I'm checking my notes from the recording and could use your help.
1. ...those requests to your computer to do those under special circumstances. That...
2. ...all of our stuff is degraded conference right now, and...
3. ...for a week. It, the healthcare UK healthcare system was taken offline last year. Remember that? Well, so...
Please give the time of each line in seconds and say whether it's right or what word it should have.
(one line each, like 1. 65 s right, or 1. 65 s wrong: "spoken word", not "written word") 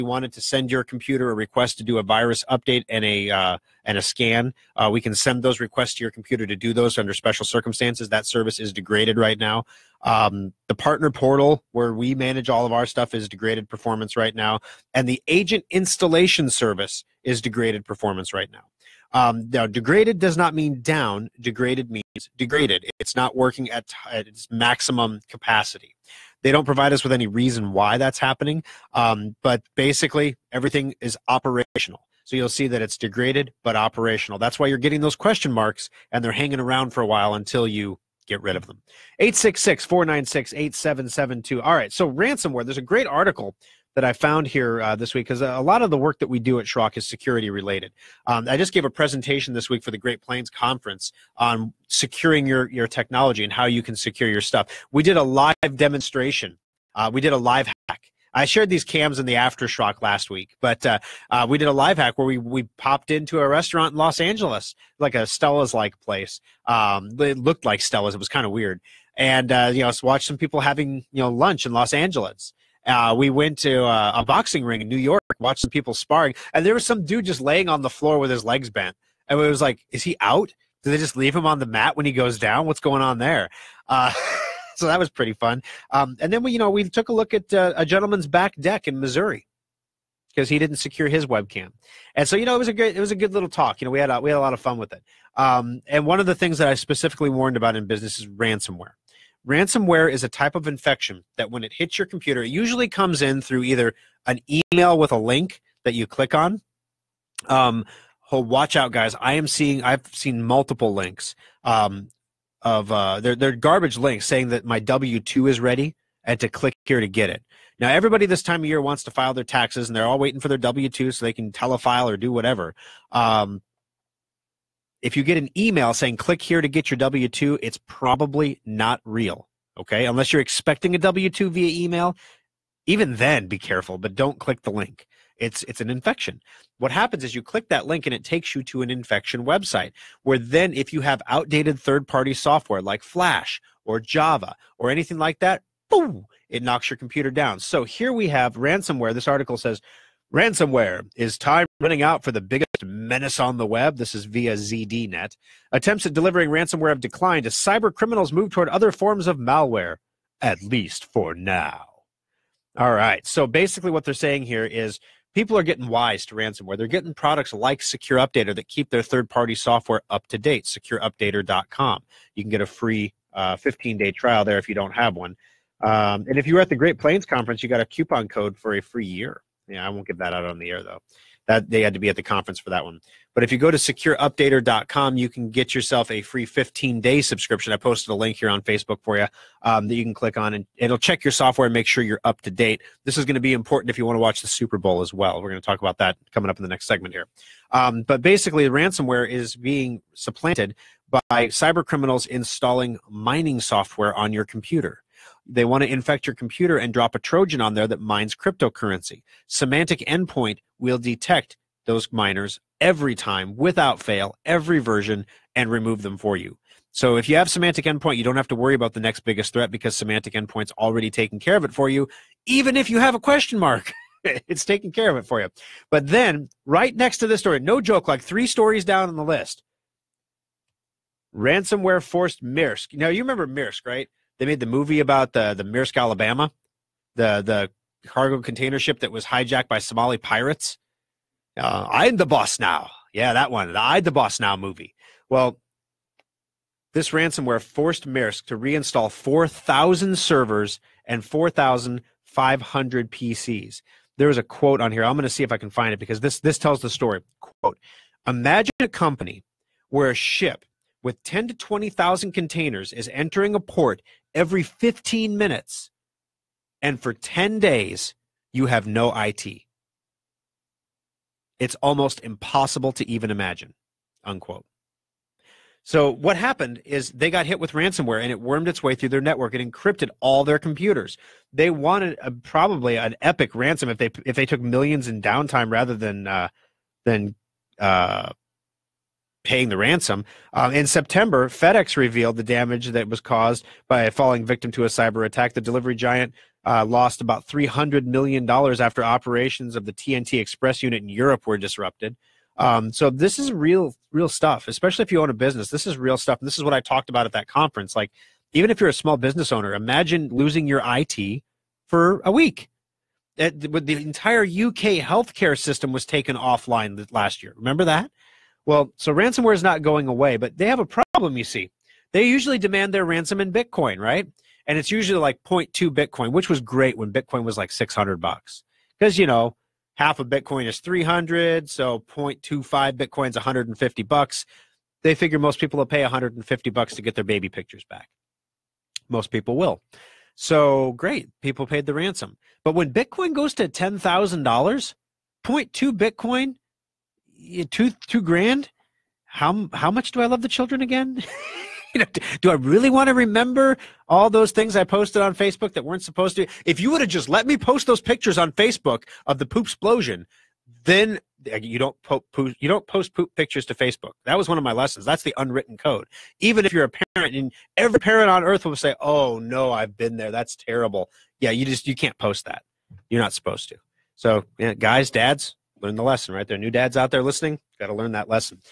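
1. 5 s right
2. 12 s wrong: "performance", not "conference"
3. 311 s wrong: "entire", not "healthcare".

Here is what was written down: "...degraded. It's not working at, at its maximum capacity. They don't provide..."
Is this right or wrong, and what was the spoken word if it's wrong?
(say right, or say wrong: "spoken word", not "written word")
right.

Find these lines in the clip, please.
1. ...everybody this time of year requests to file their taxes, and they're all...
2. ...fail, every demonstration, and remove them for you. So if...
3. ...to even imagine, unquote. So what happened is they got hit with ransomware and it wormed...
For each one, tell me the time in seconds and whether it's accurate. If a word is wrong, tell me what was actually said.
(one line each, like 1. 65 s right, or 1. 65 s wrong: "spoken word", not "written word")
1. 117 s wrong: "wants", not "requests"
2. 213 s wrong: "version", not "demonstration"
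3. 272 s right.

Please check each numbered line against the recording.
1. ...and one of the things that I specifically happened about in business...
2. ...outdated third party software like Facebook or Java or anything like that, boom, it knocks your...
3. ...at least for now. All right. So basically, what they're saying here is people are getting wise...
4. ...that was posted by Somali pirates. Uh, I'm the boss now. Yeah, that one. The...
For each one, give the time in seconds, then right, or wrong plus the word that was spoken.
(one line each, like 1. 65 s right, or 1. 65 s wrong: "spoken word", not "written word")
1. 95 s wrong: "warned", not "happened"
2. 141 s wrong: "Flash", not "Facebook"
3. 160 s right
4. 238 s wrong: "hijacked", not "posted".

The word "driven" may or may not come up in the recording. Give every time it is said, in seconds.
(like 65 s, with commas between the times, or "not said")
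not said.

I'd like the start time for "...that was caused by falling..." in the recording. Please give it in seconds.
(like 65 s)
292 s.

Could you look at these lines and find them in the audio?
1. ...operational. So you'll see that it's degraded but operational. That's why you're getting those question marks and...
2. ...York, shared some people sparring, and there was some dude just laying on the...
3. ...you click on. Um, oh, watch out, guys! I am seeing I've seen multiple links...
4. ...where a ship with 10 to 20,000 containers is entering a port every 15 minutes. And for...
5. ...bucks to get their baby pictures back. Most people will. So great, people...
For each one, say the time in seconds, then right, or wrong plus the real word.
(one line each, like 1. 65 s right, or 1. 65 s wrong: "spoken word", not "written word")
1. 31 s right
2. 74 s wrong: "watched", not "shared"
3. 105 s right
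4. 259 s right
5. 336 s right.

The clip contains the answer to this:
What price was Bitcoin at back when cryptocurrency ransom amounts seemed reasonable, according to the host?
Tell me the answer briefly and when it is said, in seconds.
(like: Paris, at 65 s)
$600, at 327 s.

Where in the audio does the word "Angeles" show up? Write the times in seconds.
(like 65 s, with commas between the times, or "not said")
64 s, 71 s.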